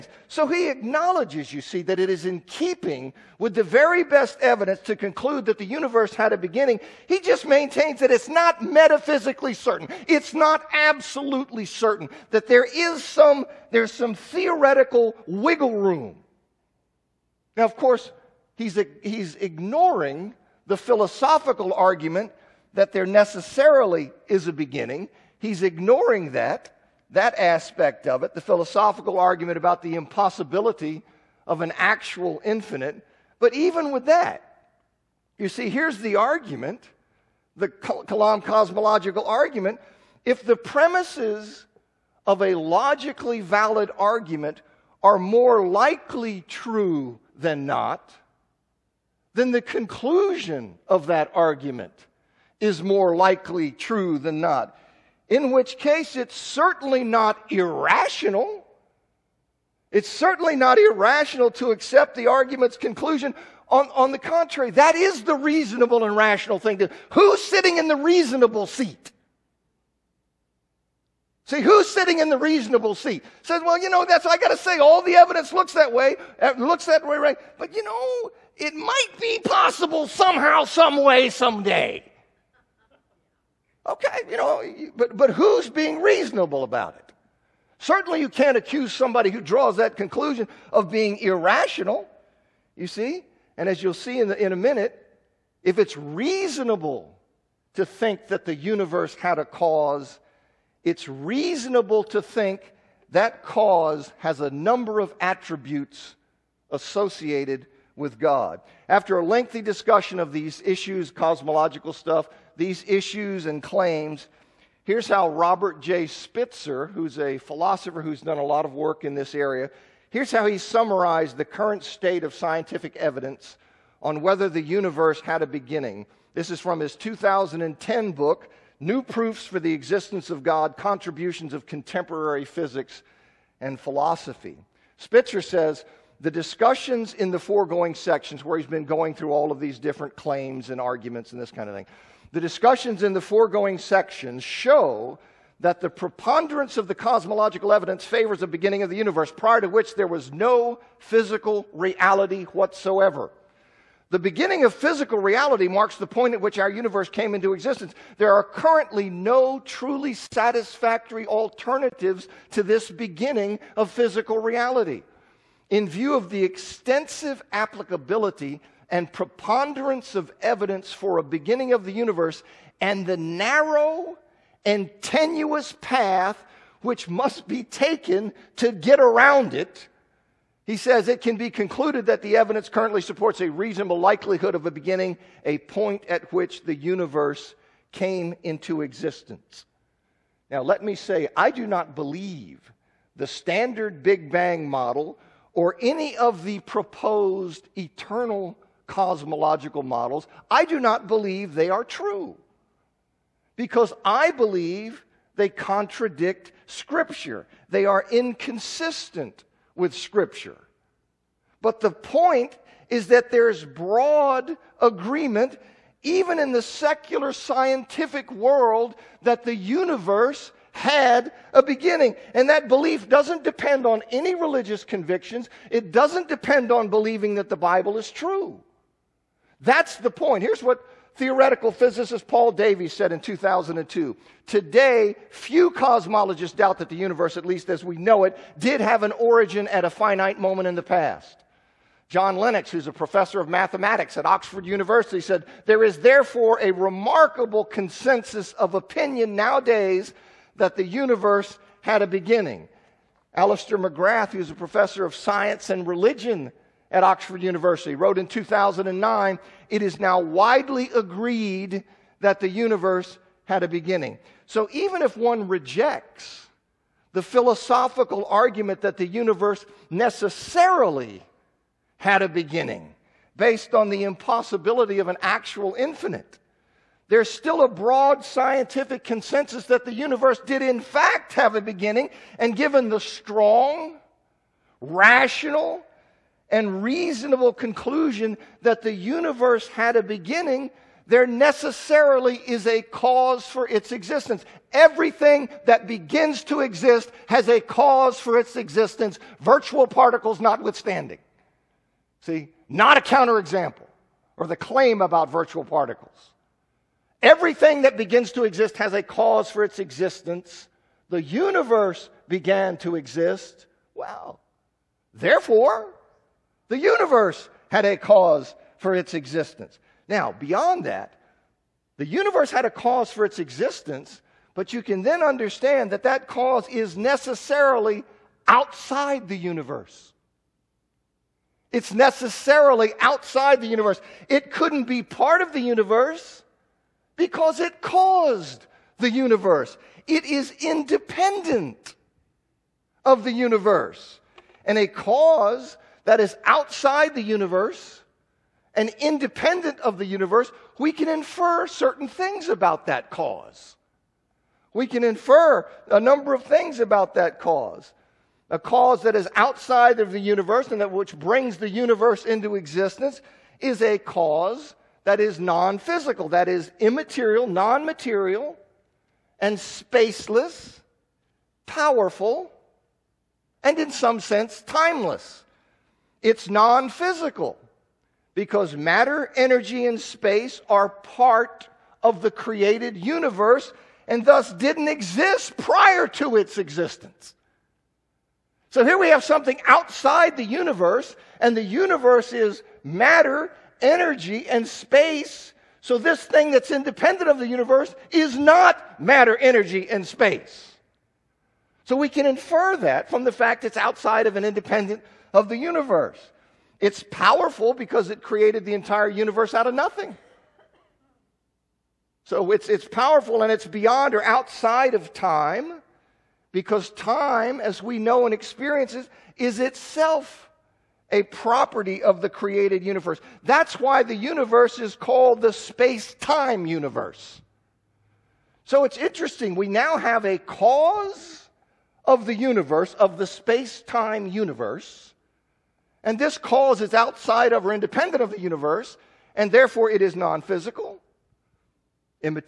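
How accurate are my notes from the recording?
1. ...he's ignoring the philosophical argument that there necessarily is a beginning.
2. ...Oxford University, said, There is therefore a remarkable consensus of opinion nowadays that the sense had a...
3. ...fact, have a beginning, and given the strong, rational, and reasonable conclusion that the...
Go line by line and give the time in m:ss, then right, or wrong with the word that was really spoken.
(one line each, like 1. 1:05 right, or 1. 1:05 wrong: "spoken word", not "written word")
1. 0:19 right
2. 4:04 wrong: "universe", not "sense"
3. 4:40 right.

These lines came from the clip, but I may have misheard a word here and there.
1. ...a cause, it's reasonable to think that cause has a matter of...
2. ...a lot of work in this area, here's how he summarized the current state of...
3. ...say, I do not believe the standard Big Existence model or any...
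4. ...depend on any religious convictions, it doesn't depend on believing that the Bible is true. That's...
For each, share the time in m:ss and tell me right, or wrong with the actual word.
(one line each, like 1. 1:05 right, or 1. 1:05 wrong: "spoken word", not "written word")
1. 1:39 wrong: "number", not "matter"
2. 1:58 right
3. 3:10 wrong: "Bang", not "Existence"
4. 3:43 right.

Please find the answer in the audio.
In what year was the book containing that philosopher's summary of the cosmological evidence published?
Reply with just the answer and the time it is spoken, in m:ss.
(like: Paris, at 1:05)
2010, at 2:06.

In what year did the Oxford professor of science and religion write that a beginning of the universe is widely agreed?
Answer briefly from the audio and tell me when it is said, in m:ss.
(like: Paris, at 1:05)
2009, at 4:18.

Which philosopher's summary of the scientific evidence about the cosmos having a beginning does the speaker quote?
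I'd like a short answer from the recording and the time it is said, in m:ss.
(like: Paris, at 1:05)
Robert J. Spitzer, at 1:55.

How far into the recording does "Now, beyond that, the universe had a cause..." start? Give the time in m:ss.
5:20.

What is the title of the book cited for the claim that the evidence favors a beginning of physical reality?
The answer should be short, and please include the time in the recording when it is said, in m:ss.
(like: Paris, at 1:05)
New Proofs for the Existence of God, at 2:08.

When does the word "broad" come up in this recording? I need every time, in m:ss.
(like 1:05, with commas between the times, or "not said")
3:33, 4:37.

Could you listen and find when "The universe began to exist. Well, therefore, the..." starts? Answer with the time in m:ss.
5:11.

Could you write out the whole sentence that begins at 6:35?
So this thing that's independent of the universe is not matter, energy, and space.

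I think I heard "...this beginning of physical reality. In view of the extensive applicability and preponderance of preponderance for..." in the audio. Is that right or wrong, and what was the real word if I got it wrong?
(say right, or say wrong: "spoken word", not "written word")
wrong: "evidence", not "preponderance".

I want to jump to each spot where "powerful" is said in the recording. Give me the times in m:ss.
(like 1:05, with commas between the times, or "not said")
6:11, 6:47, 6:52.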